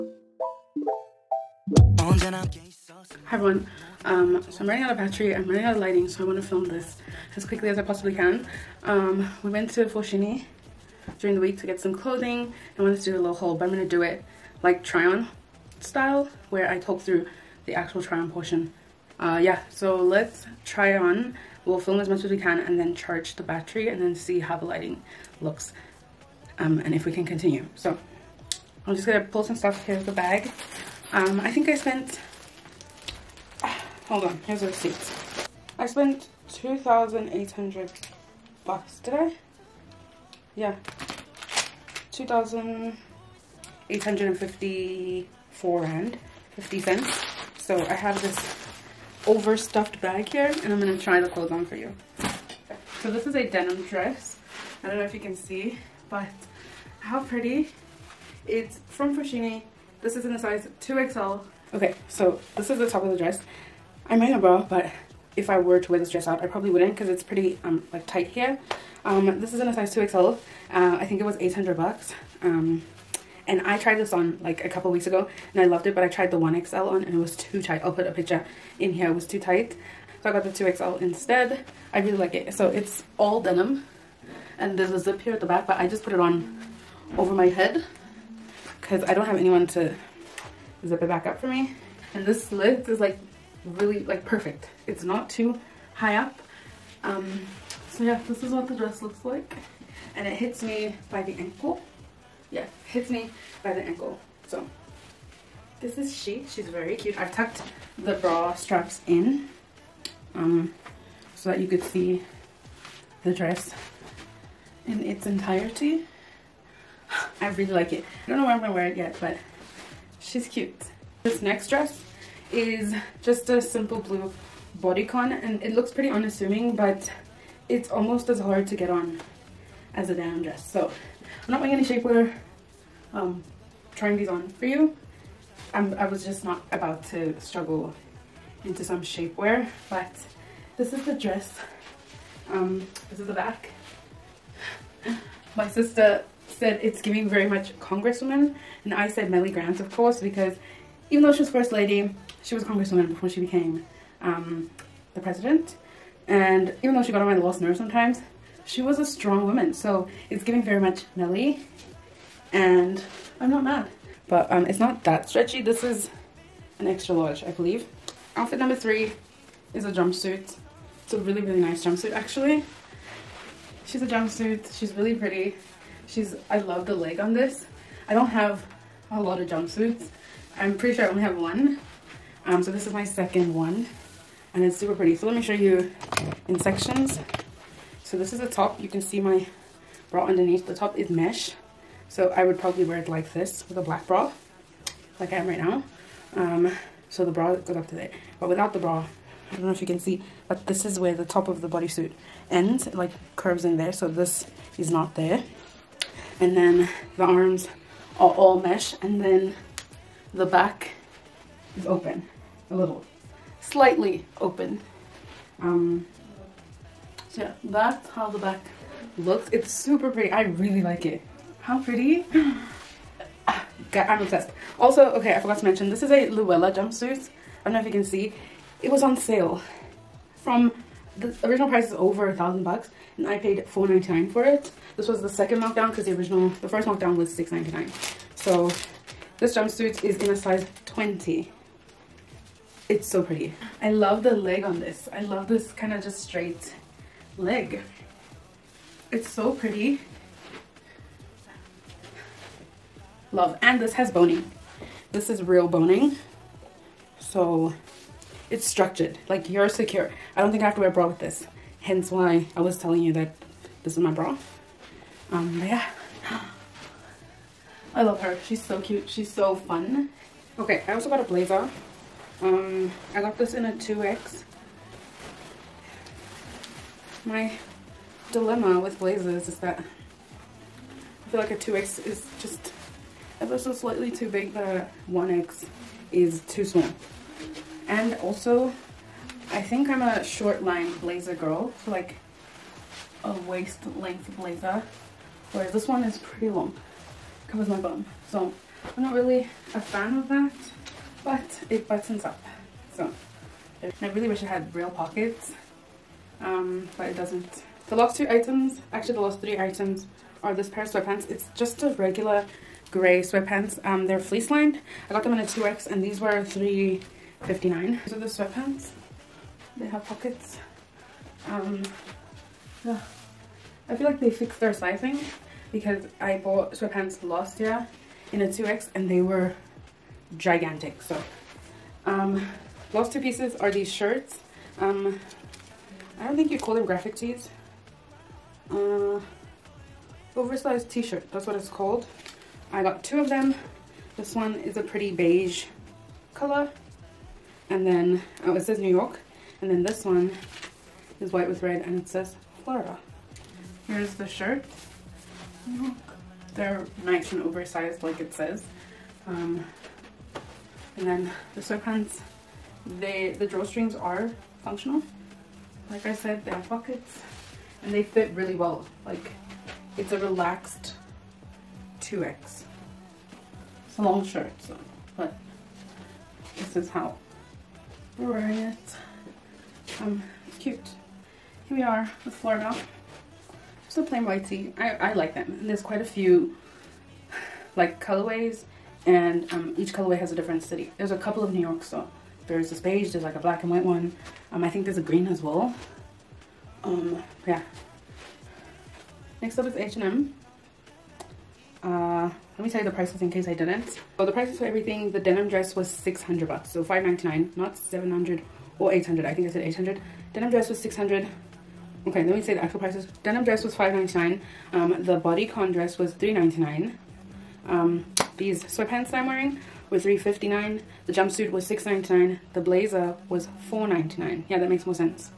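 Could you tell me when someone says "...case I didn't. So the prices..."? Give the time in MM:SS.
06:43.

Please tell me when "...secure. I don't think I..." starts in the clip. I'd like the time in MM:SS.
04:19.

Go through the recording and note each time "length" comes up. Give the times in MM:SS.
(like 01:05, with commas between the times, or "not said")
04:53.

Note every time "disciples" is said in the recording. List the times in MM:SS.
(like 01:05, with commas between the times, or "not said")
not said.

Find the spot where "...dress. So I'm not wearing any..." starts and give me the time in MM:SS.
02:10.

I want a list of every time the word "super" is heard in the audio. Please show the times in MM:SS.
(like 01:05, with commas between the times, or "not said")
03:04, 03:39.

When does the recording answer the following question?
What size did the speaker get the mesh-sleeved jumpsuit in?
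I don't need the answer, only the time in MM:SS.
04:00.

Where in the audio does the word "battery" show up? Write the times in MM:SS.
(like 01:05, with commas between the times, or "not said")
00:04, 00:23.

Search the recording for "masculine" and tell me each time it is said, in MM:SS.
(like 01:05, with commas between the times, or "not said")
not said.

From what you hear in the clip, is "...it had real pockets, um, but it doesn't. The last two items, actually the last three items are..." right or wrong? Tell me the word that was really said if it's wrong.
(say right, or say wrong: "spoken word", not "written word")
right.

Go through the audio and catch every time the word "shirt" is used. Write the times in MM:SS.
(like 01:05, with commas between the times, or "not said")
05:33, 05:40, 05:54, 06:14.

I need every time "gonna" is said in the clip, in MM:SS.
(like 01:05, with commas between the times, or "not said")
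00:29, 00:50, 01:58.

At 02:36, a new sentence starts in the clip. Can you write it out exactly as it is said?
And even though she got on my lost nerve sometimes, she was a strong woman.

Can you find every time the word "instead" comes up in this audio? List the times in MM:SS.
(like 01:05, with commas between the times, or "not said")
01:21.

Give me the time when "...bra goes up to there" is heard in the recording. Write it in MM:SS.
03:17.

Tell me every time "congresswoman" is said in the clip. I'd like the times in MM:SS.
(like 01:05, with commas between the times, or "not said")
02:27, 02:32.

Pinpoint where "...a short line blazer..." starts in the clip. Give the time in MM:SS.
04:50.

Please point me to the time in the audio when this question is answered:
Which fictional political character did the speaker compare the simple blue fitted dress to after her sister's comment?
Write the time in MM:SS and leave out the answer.
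02:29.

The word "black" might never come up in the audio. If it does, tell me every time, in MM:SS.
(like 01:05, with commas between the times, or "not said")
03:13, 06:33.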